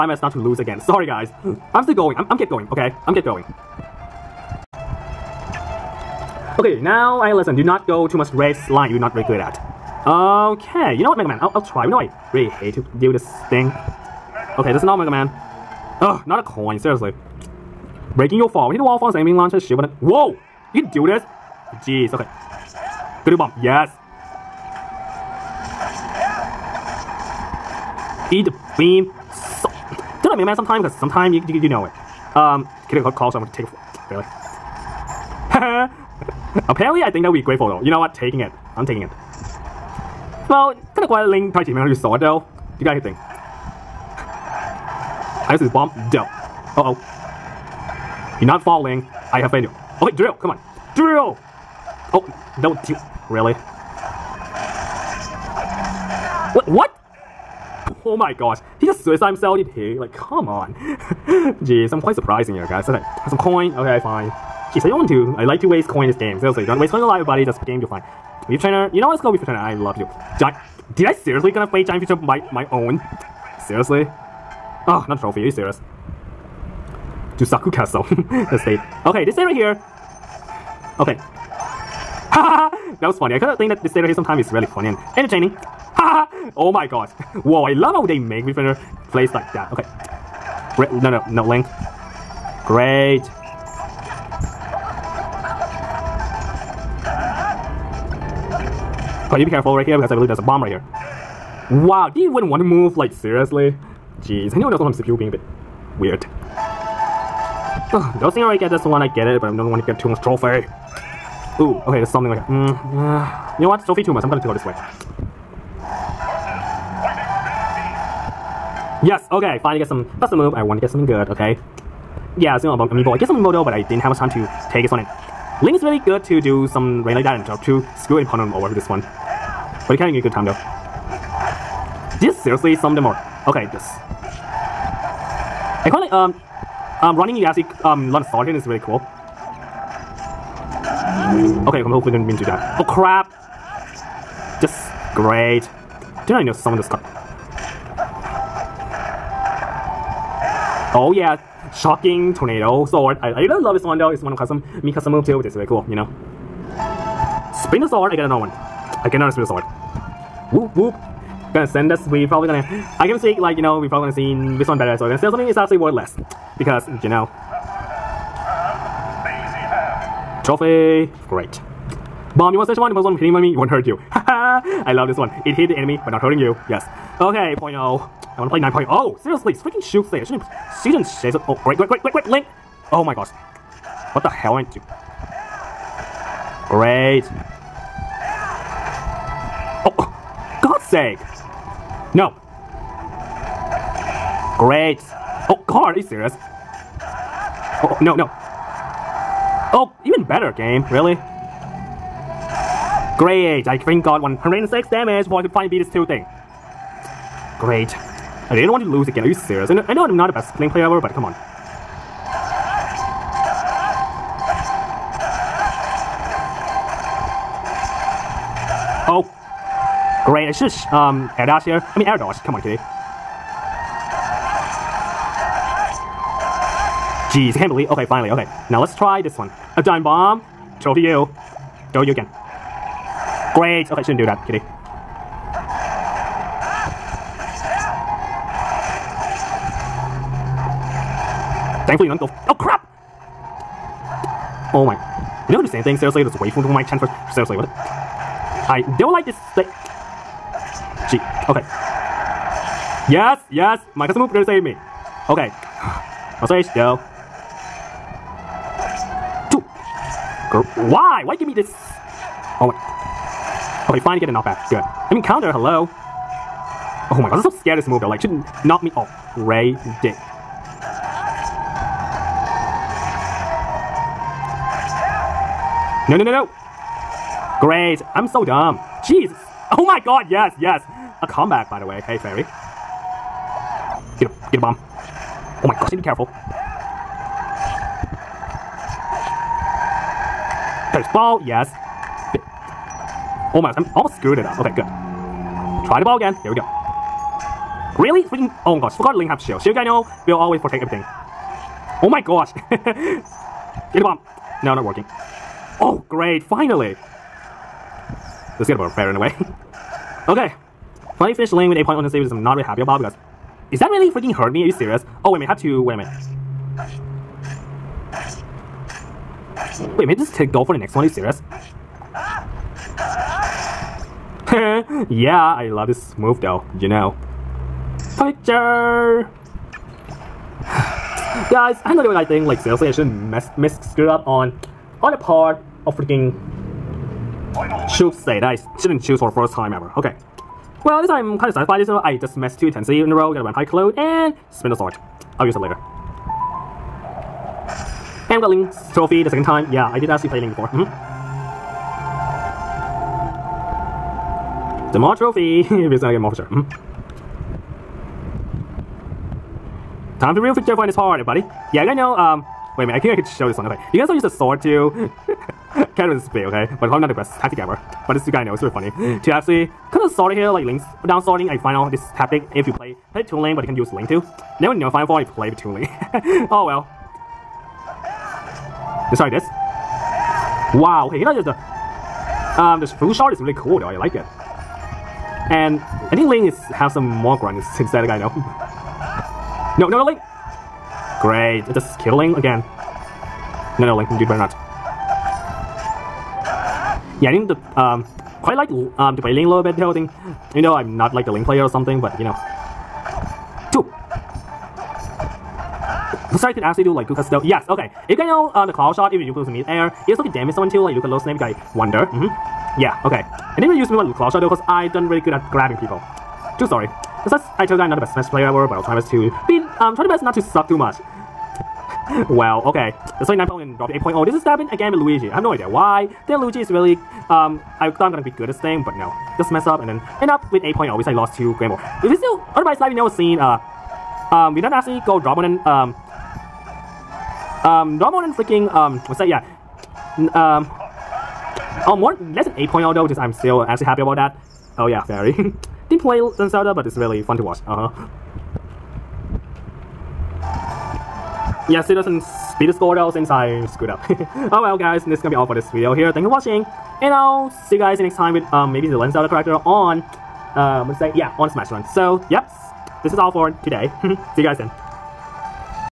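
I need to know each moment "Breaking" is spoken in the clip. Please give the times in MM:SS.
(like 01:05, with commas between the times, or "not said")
00:18.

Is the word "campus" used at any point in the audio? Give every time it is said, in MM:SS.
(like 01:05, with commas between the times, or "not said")
not said.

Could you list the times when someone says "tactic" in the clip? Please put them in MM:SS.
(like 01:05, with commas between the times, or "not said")
06:07, 06:12.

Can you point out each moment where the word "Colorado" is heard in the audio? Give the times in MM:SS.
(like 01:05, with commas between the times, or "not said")
not said.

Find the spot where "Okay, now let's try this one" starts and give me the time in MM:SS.
03:48.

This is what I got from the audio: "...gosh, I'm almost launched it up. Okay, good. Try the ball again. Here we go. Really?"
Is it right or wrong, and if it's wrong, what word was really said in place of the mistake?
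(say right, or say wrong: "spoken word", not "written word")
wrong: "screwed", not "launched".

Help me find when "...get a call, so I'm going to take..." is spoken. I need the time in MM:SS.
00:32.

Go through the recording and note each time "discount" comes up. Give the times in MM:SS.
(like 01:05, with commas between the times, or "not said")
not said.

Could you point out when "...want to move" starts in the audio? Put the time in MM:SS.
01:42.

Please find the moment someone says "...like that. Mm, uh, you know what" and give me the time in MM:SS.
01:52.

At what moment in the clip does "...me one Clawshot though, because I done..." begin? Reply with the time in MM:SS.
06:53.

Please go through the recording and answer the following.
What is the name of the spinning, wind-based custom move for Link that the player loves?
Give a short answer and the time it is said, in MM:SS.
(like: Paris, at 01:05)
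Shocking tornado sword, at 02:31.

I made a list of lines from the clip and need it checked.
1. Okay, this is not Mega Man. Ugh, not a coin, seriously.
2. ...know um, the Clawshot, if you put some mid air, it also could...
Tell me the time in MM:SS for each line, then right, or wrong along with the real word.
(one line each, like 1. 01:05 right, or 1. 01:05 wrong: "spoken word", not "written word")
1. 00:14 right
2. 06:48 right.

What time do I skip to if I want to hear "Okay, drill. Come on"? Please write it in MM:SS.
00:50.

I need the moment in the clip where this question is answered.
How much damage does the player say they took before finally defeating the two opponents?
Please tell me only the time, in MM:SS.
03:24.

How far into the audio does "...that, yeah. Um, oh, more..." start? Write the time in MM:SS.
07:19.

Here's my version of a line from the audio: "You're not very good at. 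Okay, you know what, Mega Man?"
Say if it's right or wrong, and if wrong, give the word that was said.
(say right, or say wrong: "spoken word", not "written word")
right.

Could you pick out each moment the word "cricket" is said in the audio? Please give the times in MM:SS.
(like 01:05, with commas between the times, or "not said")
not said.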